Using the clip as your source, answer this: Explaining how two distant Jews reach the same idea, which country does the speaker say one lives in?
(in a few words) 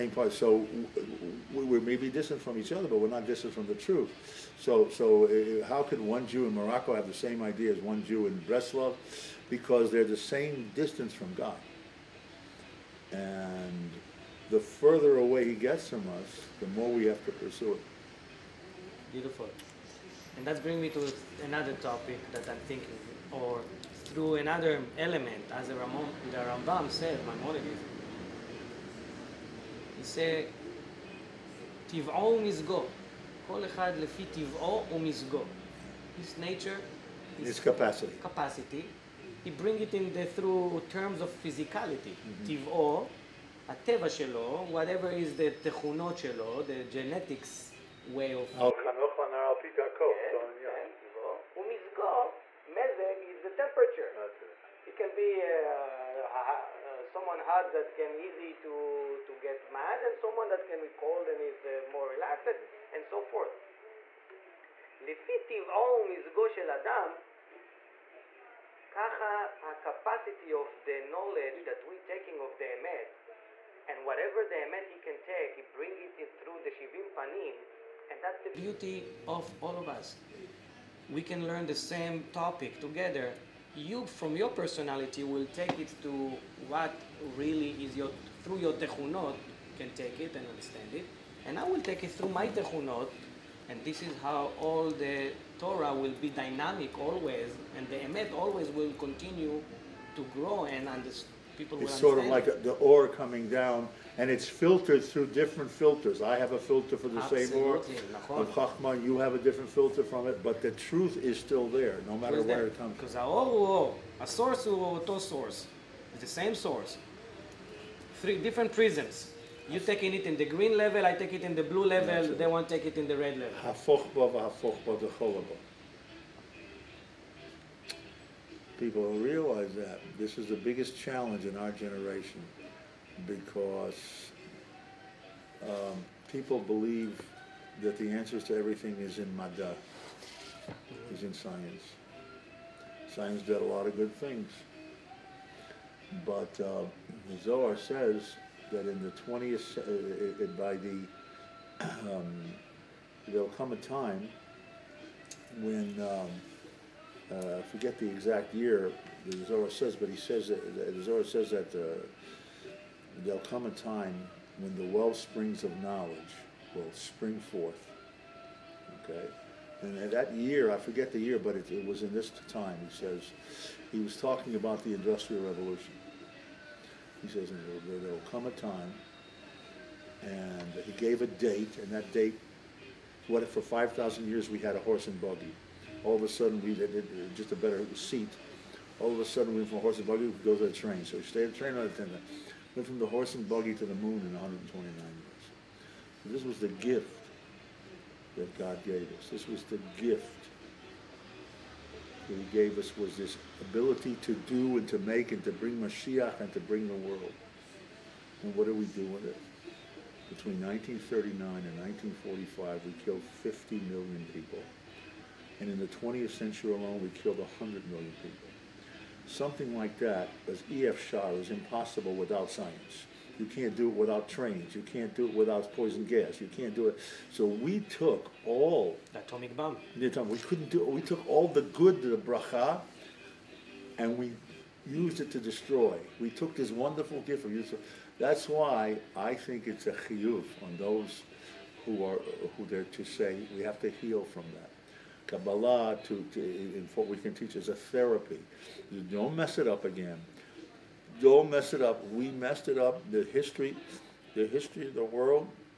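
Morocco.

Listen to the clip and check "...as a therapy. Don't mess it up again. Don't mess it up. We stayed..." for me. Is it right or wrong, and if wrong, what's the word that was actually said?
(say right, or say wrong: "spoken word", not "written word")
wrong: "messed", not "stayed".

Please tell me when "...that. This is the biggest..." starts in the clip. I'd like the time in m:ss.
2:09.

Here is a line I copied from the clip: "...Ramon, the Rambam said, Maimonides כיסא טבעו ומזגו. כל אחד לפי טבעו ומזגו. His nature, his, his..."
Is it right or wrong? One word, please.
right.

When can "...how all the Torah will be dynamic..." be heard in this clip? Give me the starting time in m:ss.
1:34.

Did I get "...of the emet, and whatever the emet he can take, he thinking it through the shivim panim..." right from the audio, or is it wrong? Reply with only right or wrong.
wrong.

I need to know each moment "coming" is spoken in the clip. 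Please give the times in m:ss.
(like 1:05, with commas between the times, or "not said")
1:43.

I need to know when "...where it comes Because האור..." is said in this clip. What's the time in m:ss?
1:52.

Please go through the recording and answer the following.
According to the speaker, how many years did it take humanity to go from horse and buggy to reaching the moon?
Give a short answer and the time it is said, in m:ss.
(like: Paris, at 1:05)
129, at 3:14.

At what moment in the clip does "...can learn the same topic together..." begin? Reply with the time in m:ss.
1:21.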